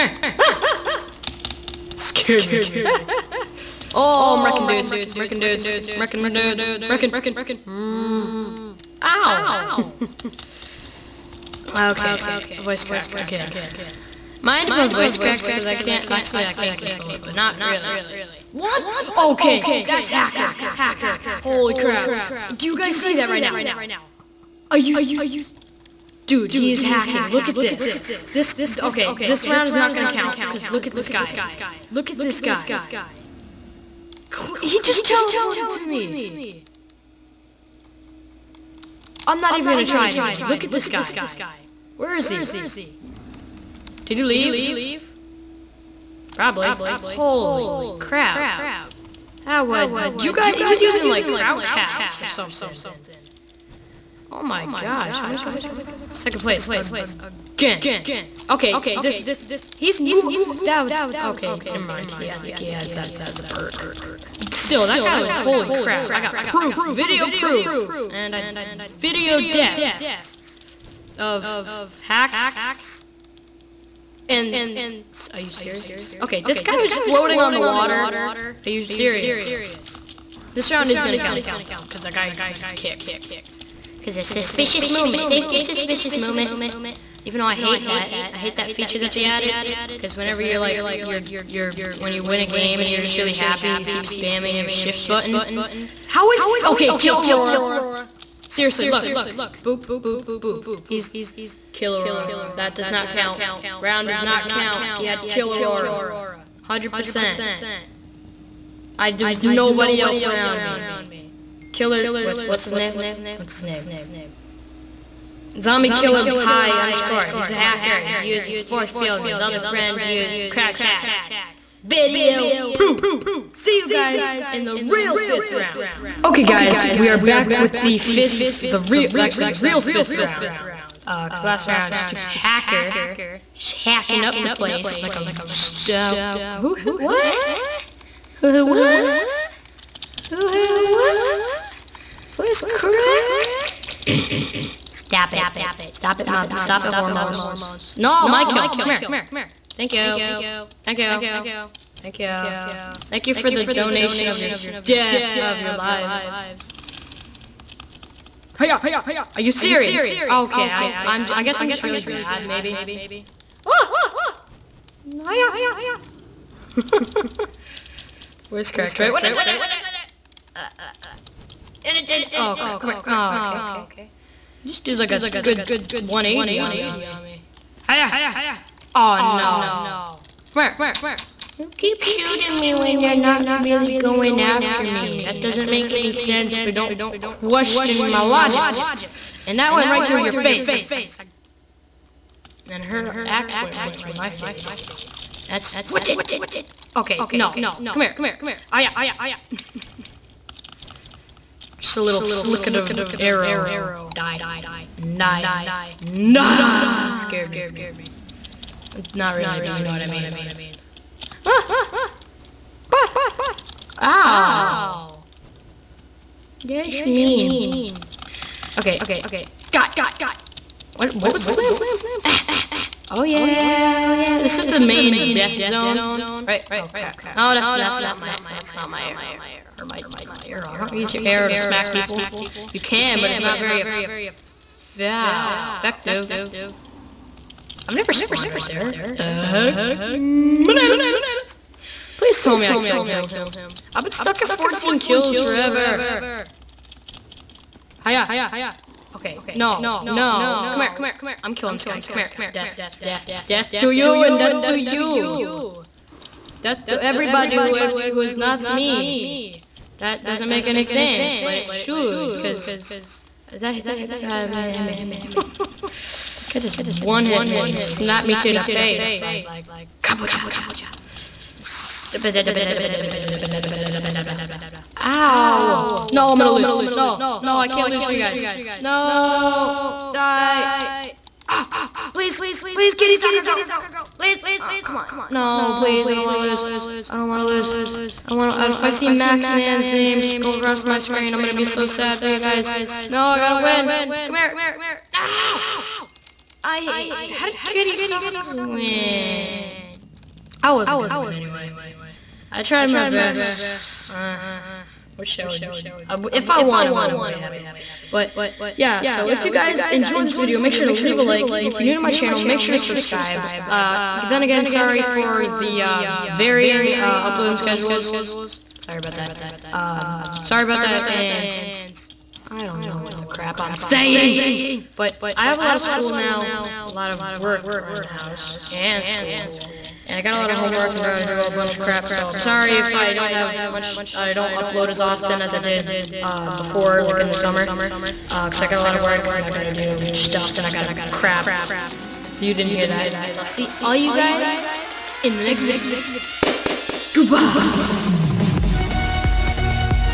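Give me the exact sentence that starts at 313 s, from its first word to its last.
Uh, then again, sorry for the uh, varying uh, uploading schedules.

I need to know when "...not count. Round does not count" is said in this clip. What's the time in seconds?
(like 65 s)
102 s.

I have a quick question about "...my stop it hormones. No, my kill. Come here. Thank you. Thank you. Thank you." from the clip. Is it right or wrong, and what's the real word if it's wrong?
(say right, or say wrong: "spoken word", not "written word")
right.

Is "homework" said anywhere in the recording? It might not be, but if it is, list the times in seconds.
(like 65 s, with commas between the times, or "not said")
330 s.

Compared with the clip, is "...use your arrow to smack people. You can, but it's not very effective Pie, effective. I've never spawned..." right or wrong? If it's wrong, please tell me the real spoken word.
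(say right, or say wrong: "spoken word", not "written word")
wrong: "Wow", not "Pie".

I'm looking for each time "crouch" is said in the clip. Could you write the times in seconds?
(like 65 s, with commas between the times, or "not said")
51 s, 120 s.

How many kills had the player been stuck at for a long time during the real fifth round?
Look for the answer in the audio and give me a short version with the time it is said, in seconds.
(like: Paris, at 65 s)
14, at 244 s.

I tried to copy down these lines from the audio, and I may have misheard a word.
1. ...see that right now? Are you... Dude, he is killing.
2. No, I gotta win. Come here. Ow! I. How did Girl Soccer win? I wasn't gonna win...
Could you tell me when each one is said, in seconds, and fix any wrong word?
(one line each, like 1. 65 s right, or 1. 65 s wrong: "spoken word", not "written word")
1. 22 s wrong: "hacking", not "killing"
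2. 293 s wrong: "Kitty", not "Girl".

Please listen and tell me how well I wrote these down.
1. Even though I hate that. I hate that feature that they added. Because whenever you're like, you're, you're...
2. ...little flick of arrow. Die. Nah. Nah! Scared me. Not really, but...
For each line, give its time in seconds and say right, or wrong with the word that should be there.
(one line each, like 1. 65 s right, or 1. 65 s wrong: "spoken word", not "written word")
1. 87 s right
2. 202 s right.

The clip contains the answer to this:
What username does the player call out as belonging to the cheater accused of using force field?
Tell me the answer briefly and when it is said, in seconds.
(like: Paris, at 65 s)
Zombie Killer Pie, at 115 s.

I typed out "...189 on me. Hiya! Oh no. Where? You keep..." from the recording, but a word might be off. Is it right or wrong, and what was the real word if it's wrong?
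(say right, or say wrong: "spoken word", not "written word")
wrong: "180", not "189".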